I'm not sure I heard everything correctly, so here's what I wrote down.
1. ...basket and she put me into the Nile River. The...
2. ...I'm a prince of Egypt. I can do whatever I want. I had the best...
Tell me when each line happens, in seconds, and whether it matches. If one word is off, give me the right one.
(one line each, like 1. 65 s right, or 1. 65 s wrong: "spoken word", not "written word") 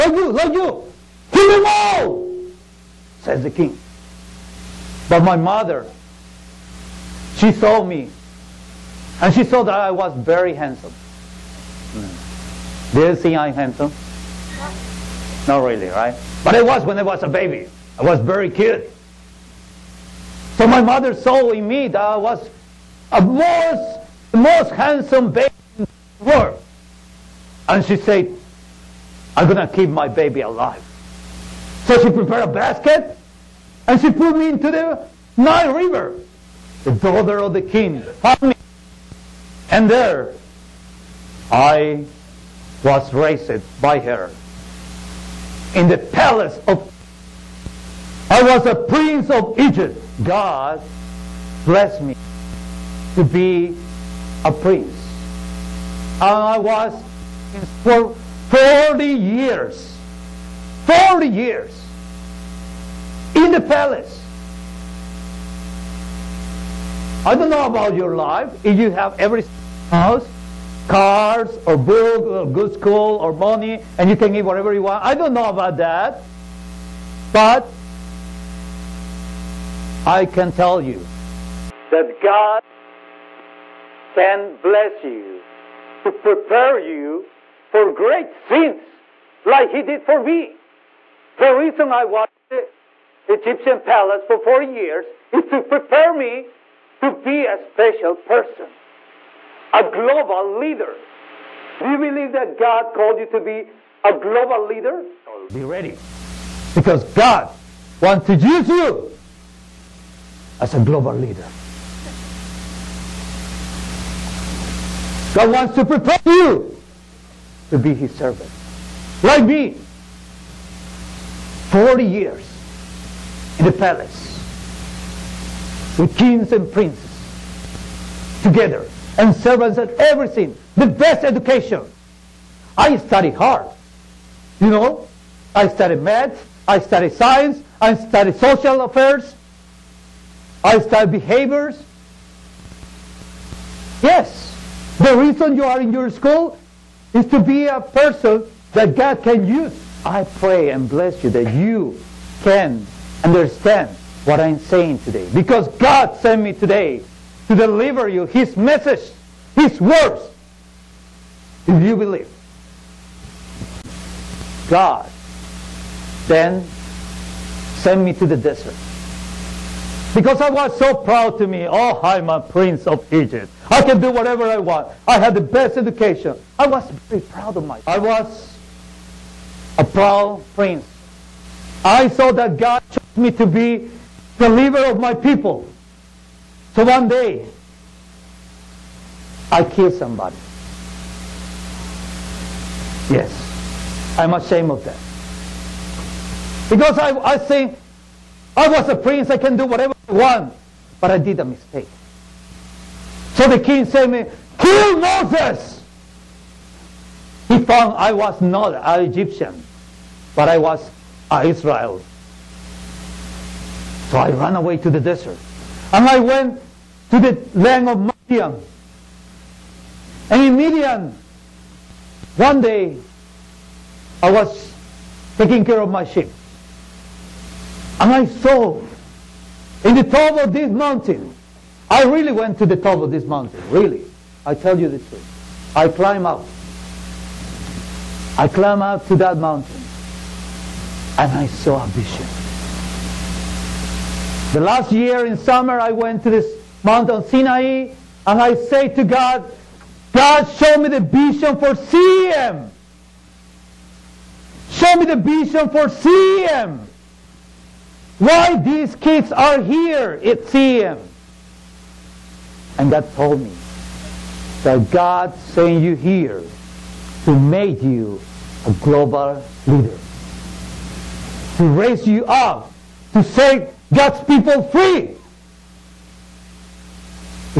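1. 32 s right
2. 172 s right.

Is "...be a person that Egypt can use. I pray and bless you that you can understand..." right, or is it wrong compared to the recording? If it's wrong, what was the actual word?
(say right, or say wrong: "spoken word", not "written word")
wrong: "God", not "Egypt".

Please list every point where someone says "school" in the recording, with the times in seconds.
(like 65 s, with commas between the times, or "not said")
72 s, 146 s.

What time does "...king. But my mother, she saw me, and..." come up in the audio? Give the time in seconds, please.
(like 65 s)
3 s.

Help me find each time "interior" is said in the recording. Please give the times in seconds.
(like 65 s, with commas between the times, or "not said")
not said.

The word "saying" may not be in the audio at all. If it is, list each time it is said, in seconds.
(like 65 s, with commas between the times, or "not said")
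154 s.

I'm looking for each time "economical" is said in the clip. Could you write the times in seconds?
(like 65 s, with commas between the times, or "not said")
not said.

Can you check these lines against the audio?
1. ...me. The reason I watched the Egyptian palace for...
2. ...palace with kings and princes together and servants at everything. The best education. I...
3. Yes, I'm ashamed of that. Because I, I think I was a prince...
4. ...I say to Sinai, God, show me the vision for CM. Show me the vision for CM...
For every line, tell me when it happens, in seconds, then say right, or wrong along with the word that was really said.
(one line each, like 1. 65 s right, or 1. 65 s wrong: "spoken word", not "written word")
1. 90 s right
2. 123 s right
3. 193 s right
4. 248 s wrong: "God", not "Sinai".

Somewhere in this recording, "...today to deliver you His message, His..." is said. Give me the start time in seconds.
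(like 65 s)
156 s.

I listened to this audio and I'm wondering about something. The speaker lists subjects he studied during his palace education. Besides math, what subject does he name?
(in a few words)
science.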